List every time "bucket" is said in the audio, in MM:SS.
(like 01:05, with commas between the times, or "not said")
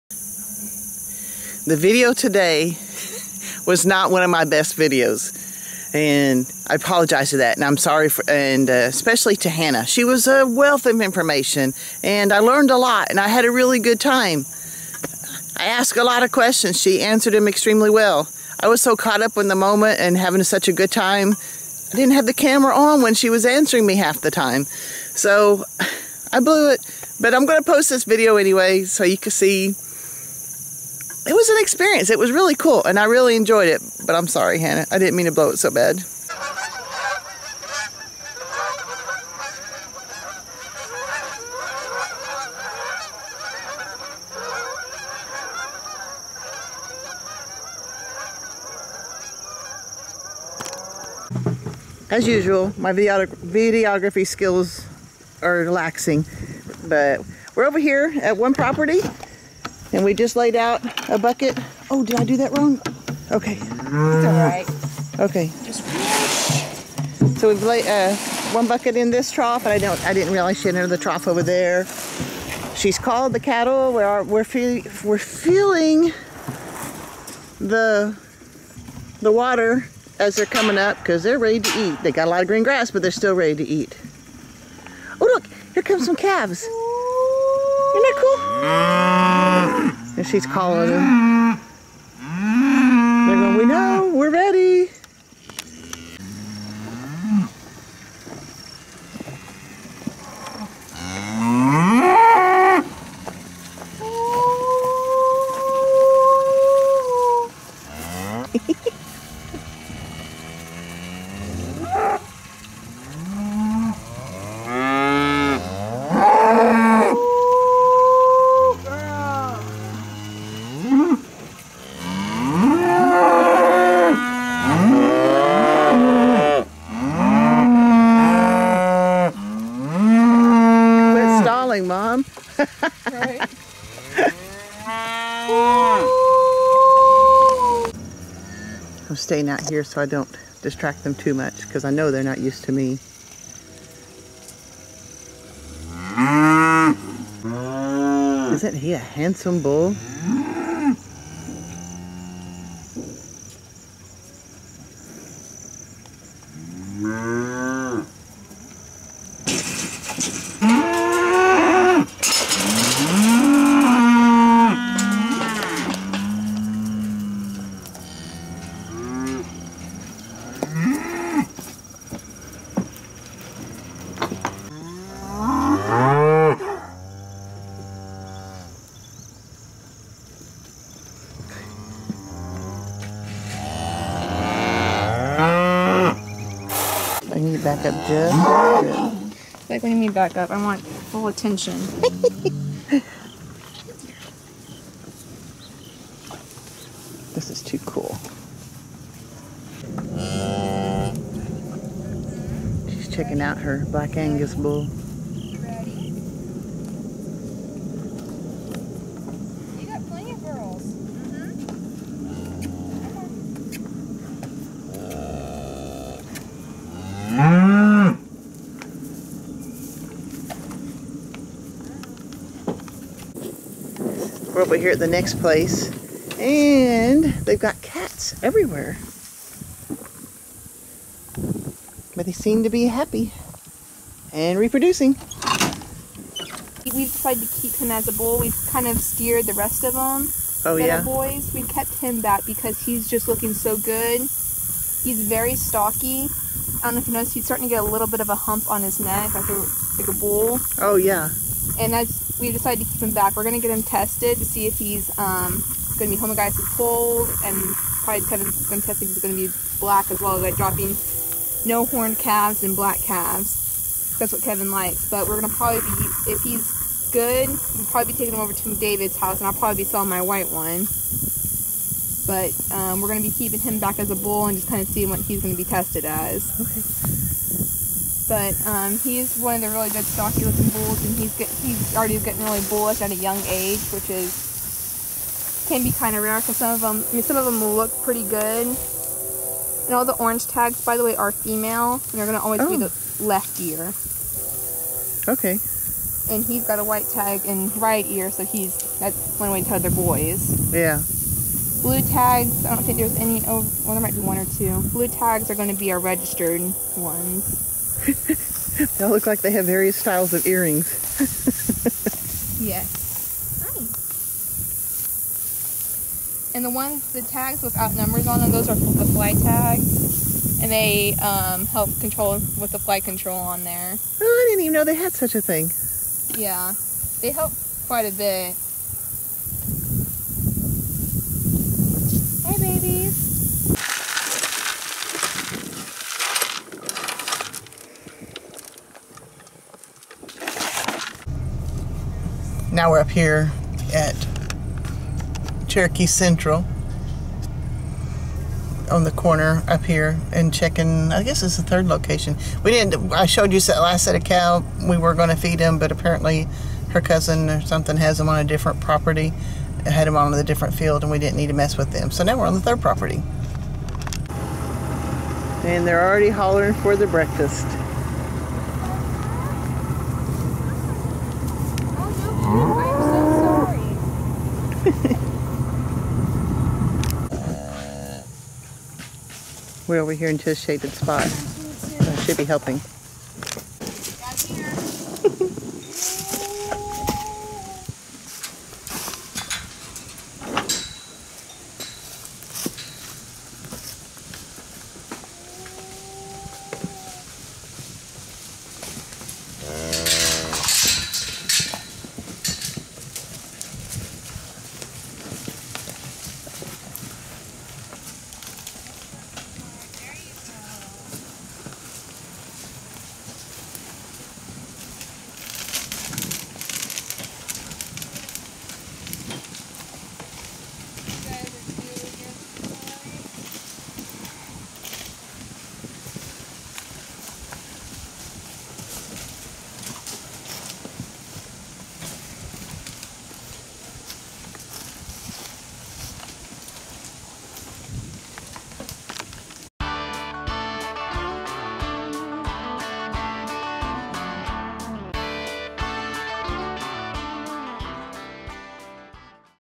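01:01, 01:08.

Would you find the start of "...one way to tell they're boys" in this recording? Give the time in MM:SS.
04:59.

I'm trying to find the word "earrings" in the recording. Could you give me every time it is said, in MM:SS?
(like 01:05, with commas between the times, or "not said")
05:10.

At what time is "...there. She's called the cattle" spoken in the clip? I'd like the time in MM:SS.
01:11.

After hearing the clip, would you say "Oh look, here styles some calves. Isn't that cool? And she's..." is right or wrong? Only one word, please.
wrong.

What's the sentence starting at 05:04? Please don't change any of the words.
Blue tags are going to be our registered ones.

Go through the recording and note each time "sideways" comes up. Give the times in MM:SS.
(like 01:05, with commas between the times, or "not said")
not said.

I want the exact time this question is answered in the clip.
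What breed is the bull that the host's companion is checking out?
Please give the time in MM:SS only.
03:23.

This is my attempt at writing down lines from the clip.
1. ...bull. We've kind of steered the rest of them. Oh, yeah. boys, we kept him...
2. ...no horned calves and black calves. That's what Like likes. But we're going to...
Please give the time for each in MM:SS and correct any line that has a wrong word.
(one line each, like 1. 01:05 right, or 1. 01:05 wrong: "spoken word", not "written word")
1. 03:58 right
2. 04:21 wrong: "Kevin", not "Like".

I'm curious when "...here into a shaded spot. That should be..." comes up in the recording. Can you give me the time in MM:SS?
06:20.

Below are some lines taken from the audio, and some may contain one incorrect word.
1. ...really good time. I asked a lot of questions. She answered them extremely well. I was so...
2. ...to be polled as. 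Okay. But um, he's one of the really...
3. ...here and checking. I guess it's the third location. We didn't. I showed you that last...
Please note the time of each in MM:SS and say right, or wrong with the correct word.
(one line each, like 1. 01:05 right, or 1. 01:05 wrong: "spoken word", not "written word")
1. 00:13 right
2. 04:35 wrong: "tested", not "polled"
3. 05:49 right.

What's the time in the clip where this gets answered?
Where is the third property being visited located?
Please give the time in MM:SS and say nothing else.
05:45.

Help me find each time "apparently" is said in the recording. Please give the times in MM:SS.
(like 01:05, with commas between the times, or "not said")
05:55.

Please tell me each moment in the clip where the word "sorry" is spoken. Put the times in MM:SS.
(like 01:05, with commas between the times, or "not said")
00:07, 00:34.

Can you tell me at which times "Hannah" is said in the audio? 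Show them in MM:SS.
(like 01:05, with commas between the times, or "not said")
00:09, 00:34.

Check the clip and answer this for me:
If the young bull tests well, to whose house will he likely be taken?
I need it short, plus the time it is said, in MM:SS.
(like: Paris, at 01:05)
David's, at 04:28.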